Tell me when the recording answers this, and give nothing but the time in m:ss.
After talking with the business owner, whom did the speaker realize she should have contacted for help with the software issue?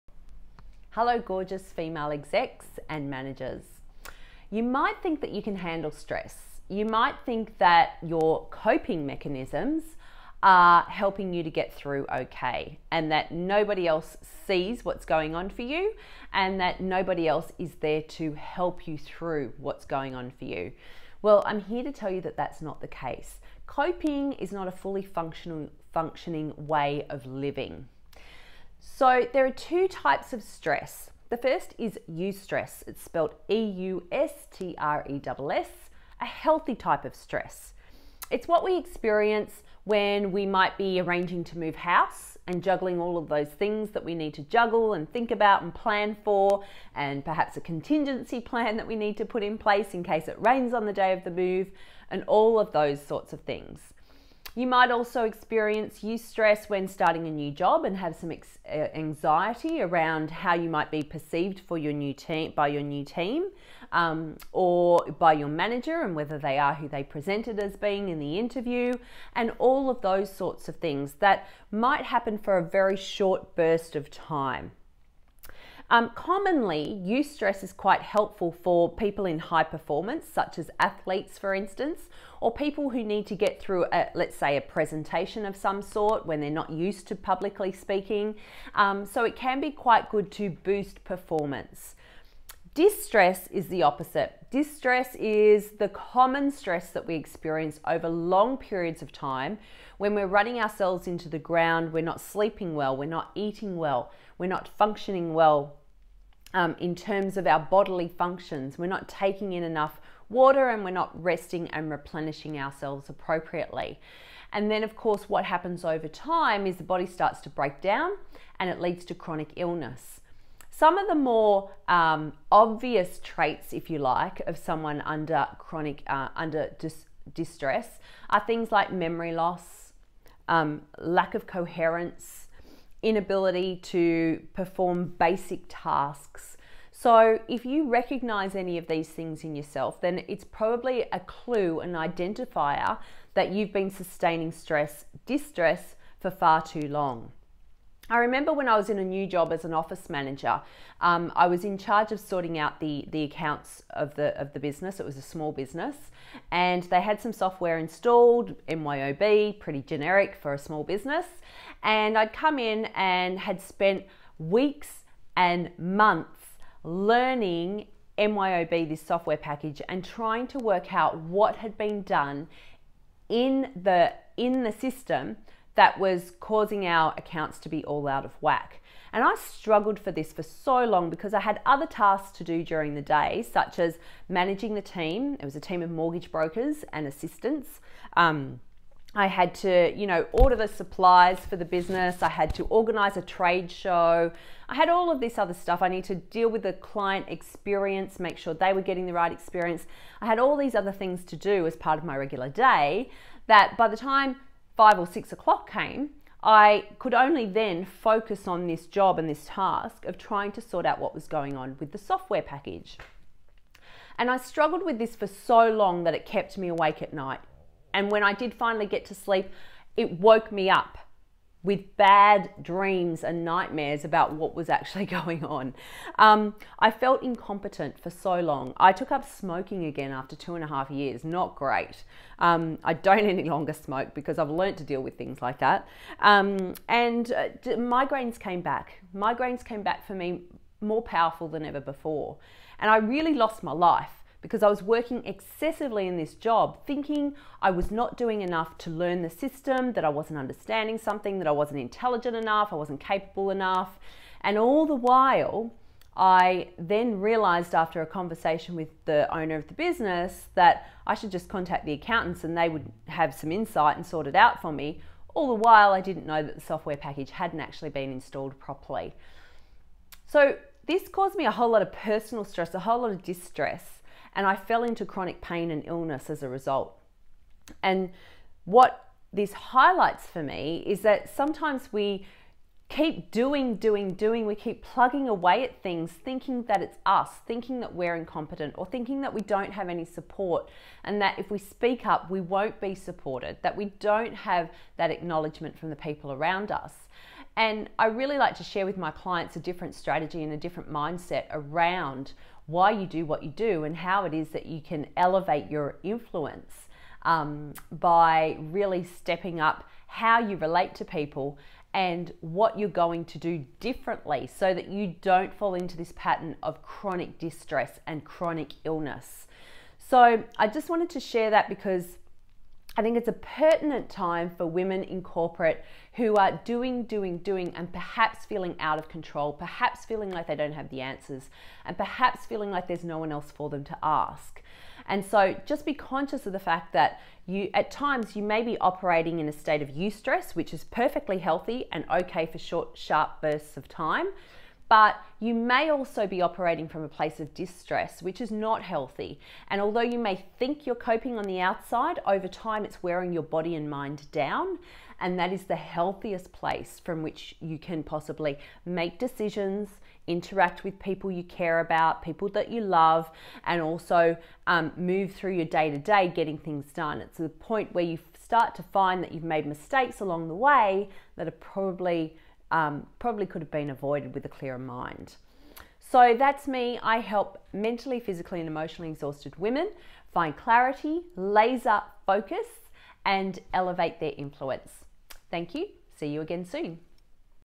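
4:21.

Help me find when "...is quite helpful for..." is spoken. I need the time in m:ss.
1:17.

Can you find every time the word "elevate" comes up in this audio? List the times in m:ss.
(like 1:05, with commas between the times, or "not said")
5:05, 6:23.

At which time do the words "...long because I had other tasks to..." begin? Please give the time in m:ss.
3:00.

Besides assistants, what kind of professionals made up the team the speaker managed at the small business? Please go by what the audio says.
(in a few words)
Mortgage brokers.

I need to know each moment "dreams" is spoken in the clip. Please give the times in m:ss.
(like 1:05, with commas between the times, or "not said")
3:42.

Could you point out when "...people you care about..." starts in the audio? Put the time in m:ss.
6:00.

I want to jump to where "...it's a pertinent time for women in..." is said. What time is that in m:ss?
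5:23.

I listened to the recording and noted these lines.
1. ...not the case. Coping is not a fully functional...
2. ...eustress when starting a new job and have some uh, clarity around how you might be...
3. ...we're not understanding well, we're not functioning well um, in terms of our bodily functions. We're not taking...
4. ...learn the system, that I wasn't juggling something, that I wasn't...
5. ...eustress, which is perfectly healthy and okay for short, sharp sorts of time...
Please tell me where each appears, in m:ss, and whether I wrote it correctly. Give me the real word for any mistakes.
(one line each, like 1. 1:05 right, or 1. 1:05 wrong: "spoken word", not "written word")
1. 0:22 right
2. 0:56 wrong: "anxiety", not "clarity"
3. 1:42 wrong: "eating", not "understanding"
4. 4:08 wrong: "understanding", not "juggling"
5. 5:39 wrong: "bursts", not "sorts".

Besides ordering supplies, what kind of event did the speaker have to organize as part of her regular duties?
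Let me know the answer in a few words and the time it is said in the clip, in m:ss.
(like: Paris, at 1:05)
A trade show, at 3:13.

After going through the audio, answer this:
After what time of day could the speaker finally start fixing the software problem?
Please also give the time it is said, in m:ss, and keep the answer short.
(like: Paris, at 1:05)
5 or 6 o'clock, at 3:24.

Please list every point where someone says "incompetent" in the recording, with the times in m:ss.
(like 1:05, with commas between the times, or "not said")
3:47, 4:48.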